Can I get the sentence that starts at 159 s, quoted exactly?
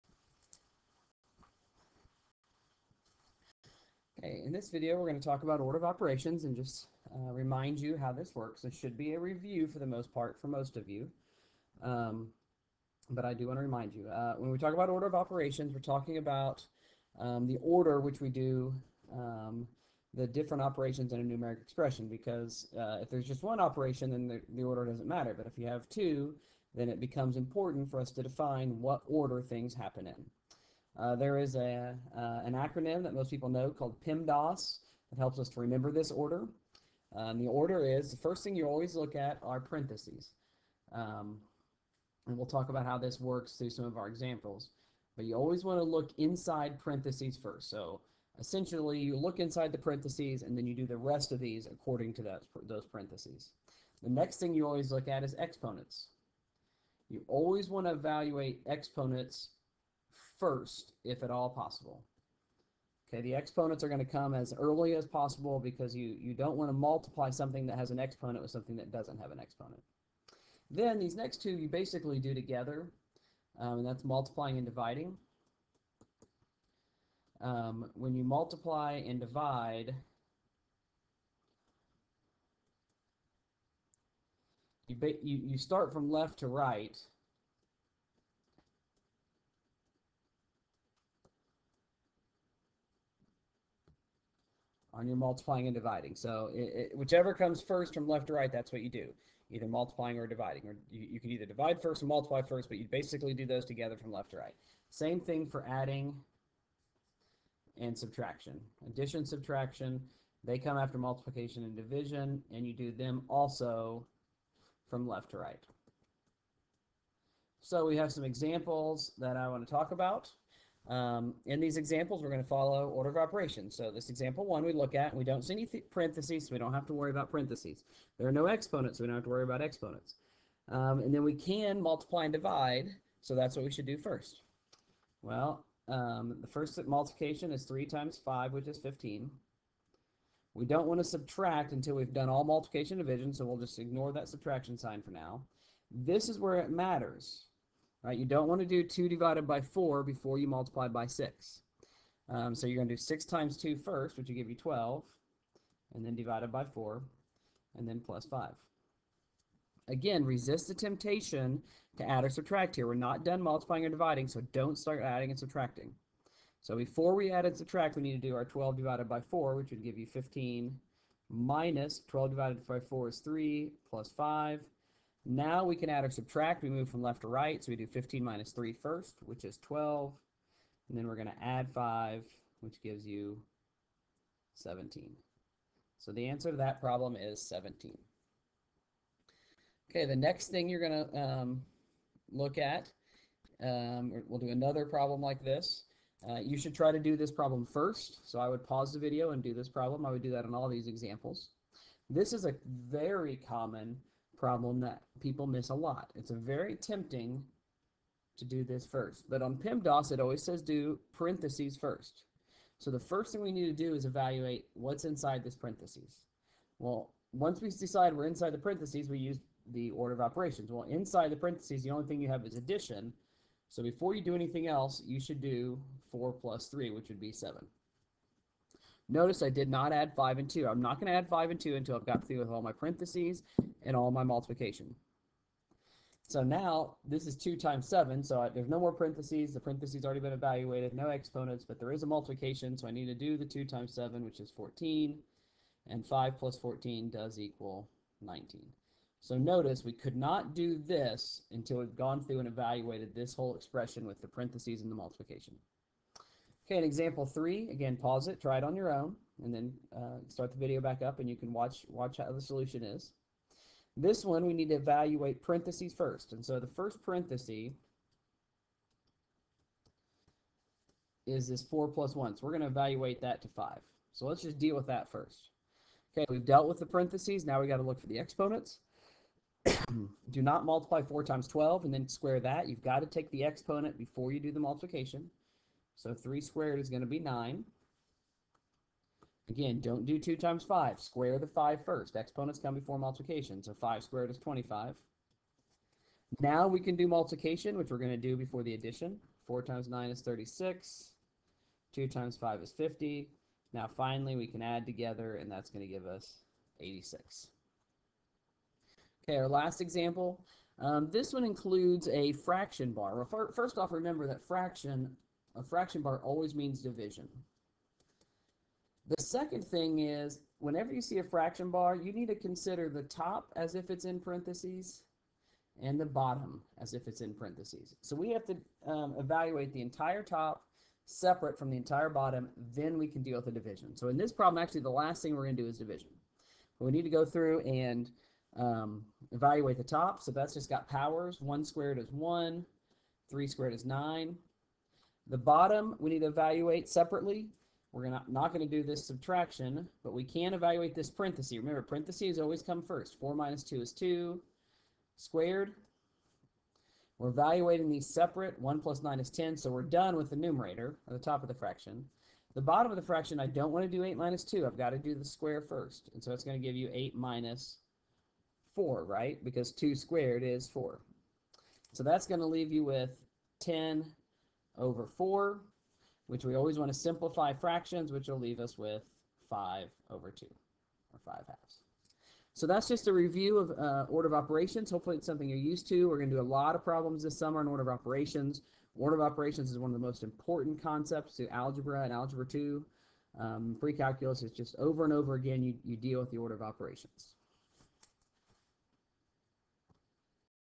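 Again, resist the temptation to add or subtract here.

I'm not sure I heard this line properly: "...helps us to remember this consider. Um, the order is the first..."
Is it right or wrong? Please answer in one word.
wrong.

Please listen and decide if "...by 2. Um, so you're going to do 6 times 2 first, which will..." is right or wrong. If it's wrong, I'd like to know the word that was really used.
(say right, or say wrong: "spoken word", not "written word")
wrong: "6", not "2".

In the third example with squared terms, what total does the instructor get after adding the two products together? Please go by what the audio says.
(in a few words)
86.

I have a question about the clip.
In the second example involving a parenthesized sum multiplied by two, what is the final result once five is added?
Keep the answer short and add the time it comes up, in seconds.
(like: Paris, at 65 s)
19, at 247 s.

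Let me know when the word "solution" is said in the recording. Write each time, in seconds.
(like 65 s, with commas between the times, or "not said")
262 s.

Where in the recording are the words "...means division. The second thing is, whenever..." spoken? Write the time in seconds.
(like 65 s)
316 s.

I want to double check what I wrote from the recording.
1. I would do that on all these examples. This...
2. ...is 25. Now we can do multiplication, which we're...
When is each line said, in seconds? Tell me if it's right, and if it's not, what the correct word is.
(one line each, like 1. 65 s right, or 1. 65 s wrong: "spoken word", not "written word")
1. 200 s right
2. 294 s right.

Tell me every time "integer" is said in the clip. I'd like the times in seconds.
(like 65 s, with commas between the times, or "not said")
not said.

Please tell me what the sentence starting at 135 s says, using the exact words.
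Well, um, the first multiplication is 3 times 5, which is 15.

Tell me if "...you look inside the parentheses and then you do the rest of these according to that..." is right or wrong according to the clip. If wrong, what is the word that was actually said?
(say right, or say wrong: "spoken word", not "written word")
right.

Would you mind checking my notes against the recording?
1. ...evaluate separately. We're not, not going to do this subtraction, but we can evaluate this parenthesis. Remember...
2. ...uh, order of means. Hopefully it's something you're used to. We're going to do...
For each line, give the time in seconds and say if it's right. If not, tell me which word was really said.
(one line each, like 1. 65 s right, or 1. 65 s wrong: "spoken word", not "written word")
1. 346 s right
2. 383 s wrong: "operations", not "means".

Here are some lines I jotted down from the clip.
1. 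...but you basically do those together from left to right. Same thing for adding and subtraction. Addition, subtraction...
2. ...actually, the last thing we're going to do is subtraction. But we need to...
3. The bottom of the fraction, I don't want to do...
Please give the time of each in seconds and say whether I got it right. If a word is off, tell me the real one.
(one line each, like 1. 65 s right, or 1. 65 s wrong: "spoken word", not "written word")
1. 102 s right
2. 334 s wrong: "division", not "subtraction"
3. 362 s right.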